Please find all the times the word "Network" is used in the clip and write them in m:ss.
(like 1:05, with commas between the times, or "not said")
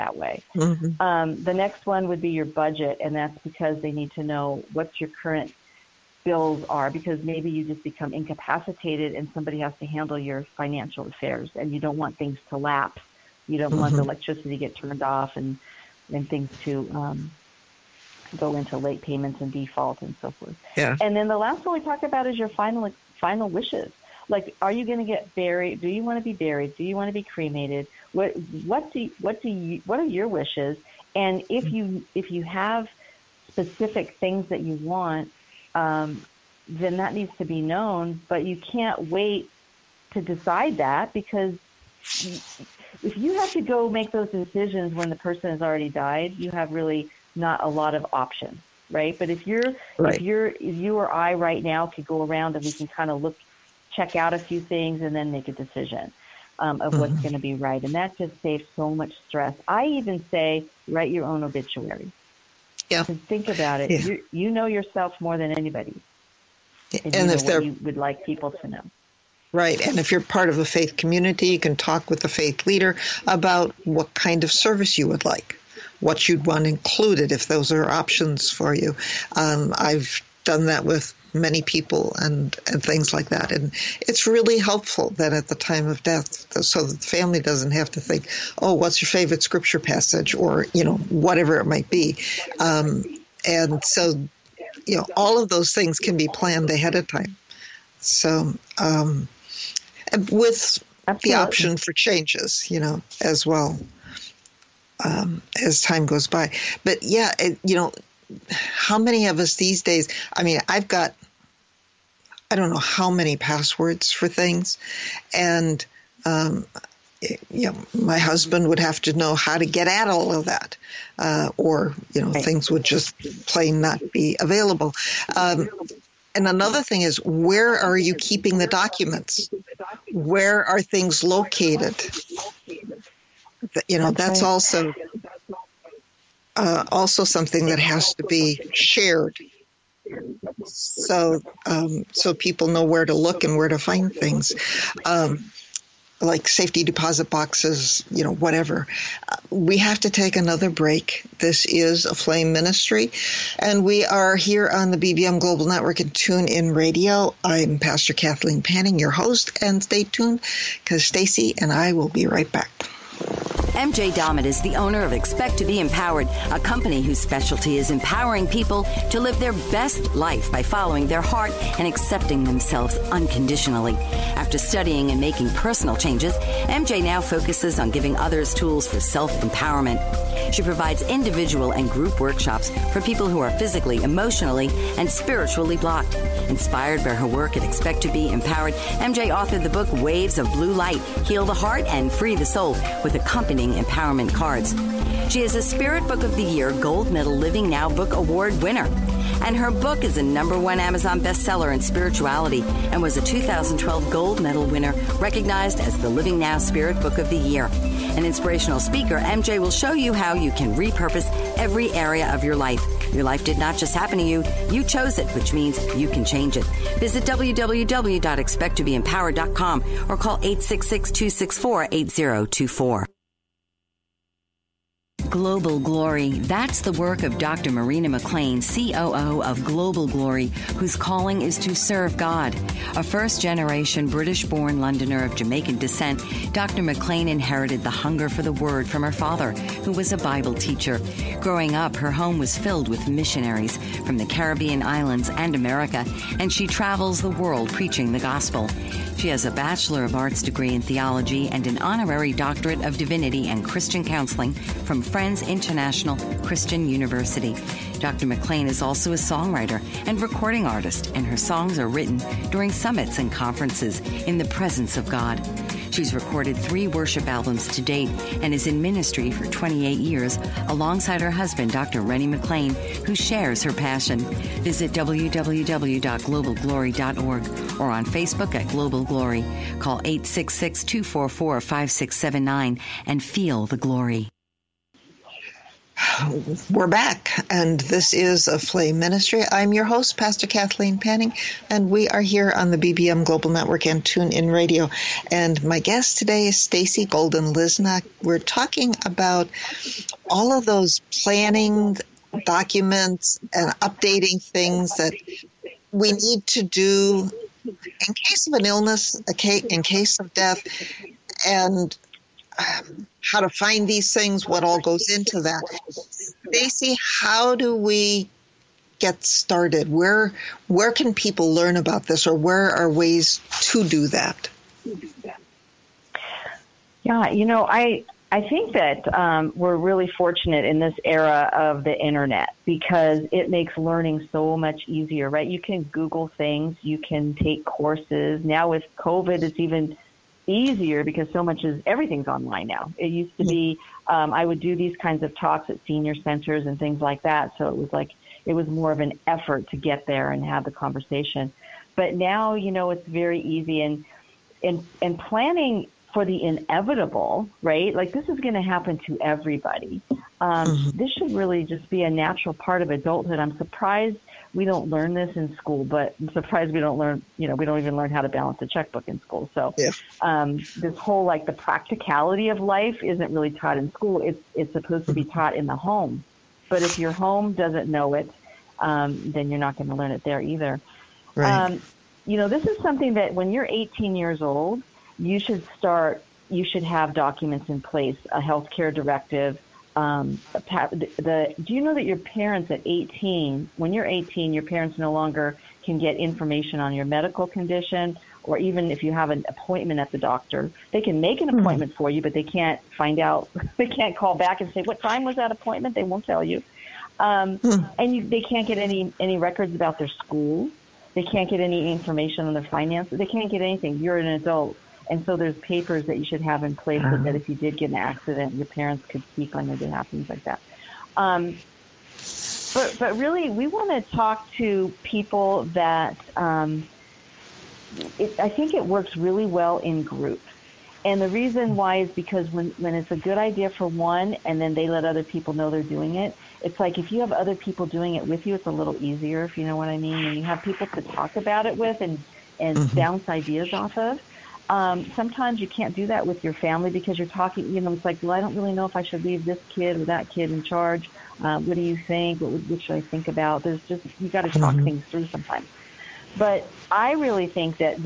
2:35, 4:53.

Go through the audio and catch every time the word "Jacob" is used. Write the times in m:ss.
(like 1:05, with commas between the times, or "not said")
not said.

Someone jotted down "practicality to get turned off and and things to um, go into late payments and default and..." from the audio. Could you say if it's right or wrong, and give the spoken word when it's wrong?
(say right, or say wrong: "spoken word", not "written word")
wrong: "electricity", not "practicality".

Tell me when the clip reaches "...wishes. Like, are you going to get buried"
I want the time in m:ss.
0:23.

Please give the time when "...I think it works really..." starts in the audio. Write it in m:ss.
7:08.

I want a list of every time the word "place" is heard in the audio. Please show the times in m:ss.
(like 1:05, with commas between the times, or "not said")
6:27, 6:56.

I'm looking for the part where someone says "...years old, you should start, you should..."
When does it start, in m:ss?
6:24.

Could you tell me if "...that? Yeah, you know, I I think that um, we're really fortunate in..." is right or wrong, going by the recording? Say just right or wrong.
right.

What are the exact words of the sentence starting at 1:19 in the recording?
Um, I've done that with many people and, and things like that.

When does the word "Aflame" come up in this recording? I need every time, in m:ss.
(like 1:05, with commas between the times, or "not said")
2:32, 4:48.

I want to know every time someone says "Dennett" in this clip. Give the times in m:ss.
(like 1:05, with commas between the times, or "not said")
not said.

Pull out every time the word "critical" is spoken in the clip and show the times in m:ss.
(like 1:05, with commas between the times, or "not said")
not said.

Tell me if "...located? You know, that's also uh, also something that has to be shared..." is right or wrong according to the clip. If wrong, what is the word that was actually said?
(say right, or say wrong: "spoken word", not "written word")
right.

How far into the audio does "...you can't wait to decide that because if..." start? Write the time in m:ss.
0:38.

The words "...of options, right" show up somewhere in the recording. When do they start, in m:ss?
0:47.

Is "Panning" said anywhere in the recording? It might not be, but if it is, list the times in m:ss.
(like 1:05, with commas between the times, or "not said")
2:38, 4:50.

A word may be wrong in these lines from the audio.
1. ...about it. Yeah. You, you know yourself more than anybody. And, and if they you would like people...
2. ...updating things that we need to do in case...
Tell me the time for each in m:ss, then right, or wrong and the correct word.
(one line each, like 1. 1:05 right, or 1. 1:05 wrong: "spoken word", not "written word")
1. 1:03 right
2. 5:03 right.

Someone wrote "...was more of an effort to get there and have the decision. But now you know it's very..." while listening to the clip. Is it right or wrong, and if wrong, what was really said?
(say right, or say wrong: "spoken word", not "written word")
wrong: "conversation", not "decision".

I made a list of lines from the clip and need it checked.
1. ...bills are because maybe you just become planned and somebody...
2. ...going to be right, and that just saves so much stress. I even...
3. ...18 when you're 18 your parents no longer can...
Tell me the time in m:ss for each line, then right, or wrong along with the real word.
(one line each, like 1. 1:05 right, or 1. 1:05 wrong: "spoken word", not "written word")
1. 0:06 wrong: "incapacitated", not "planned"
2. 0:57 right
3. 6:32 right.